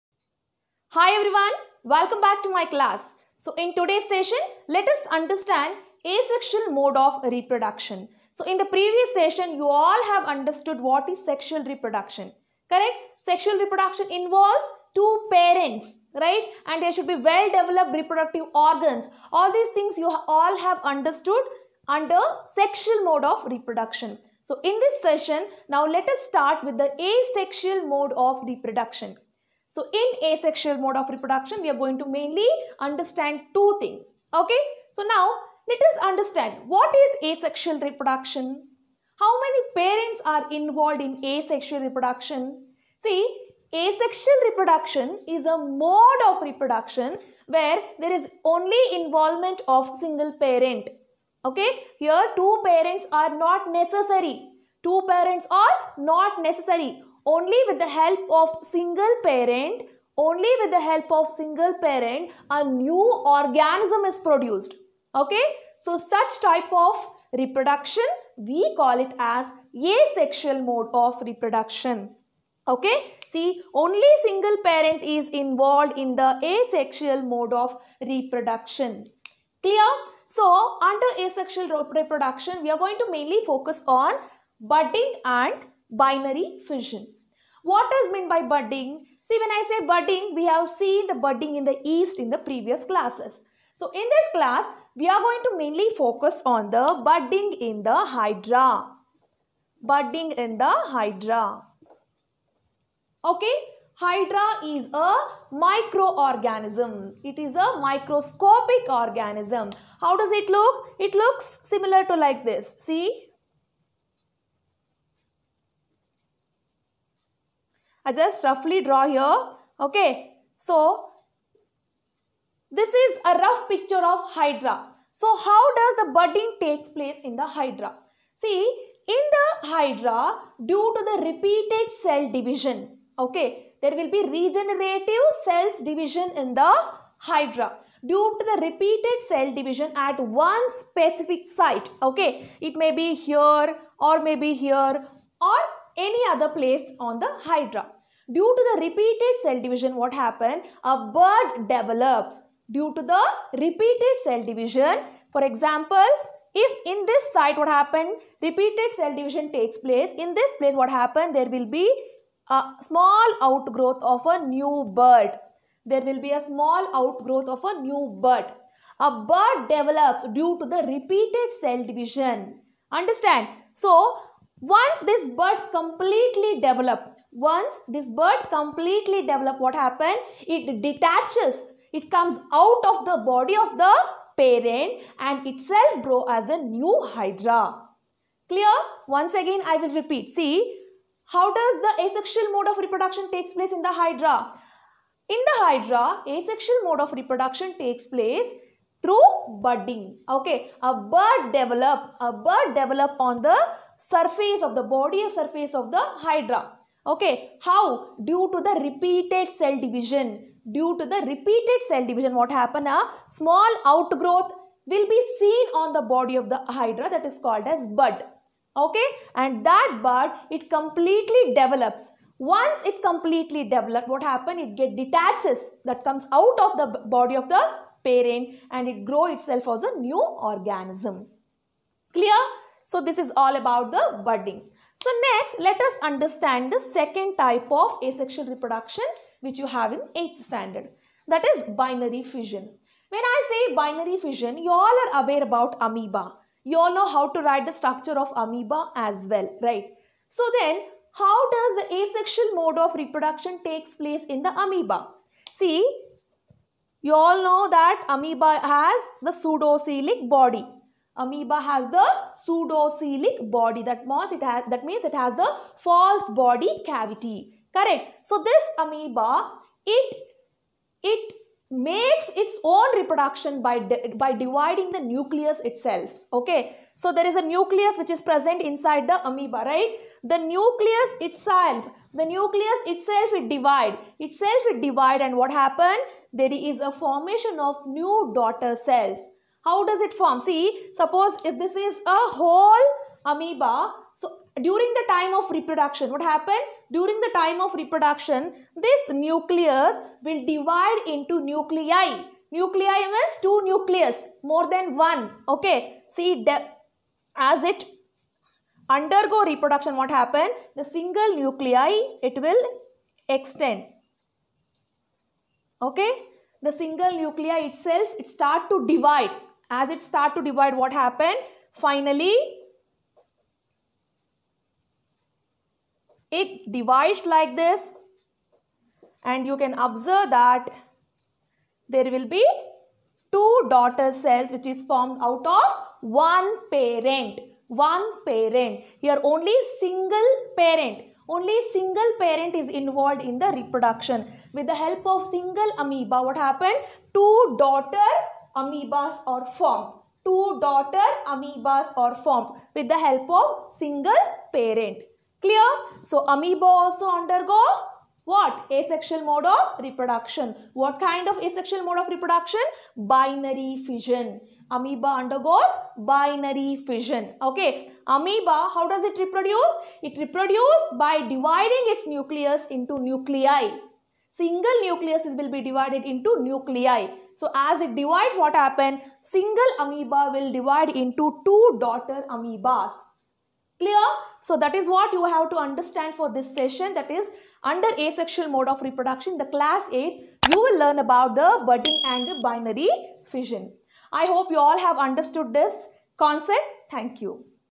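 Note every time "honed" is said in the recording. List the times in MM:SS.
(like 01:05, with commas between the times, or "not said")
not said.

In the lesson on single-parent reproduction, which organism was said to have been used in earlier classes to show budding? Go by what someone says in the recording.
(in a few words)
Yeast.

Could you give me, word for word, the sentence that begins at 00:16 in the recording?
And there should be well developed reproductive organs.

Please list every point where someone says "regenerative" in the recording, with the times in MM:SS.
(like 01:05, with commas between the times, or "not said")
02:14.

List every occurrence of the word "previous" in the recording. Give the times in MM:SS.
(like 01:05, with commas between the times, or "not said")
00:08, 01:32.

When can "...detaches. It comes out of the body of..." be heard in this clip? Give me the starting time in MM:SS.
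03:00.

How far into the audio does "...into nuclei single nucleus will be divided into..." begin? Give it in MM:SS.
06:12.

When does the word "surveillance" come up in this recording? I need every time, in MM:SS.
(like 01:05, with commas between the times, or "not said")
not said.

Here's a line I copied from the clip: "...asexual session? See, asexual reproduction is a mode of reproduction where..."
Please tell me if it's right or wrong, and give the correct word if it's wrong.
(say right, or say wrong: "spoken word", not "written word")
wrong: "reproduction", not "session".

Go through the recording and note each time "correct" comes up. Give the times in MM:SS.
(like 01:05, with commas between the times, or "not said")
00:12, 04:27.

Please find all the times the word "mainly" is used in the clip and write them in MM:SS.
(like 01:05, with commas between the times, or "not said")
00:32, 01:23, 01:35.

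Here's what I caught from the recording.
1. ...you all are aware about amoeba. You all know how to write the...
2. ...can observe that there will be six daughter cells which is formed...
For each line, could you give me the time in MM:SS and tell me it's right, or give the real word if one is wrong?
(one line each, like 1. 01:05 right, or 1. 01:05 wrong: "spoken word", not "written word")
1. 04:04 right
2. 05:29 wrong: "two", not "six".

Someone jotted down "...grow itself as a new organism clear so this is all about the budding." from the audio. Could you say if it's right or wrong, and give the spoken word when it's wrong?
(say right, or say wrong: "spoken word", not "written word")
right.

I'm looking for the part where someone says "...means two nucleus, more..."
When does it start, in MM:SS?
05:03.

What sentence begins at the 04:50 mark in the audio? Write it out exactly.
See, suppose if this is a whole amoeba, so during the time of reproduction, what happened?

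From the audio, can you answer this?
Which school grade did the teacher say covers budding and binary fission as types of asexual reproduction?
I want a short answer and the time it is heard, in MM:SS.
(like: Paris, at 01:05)
8th standard, at 04:00.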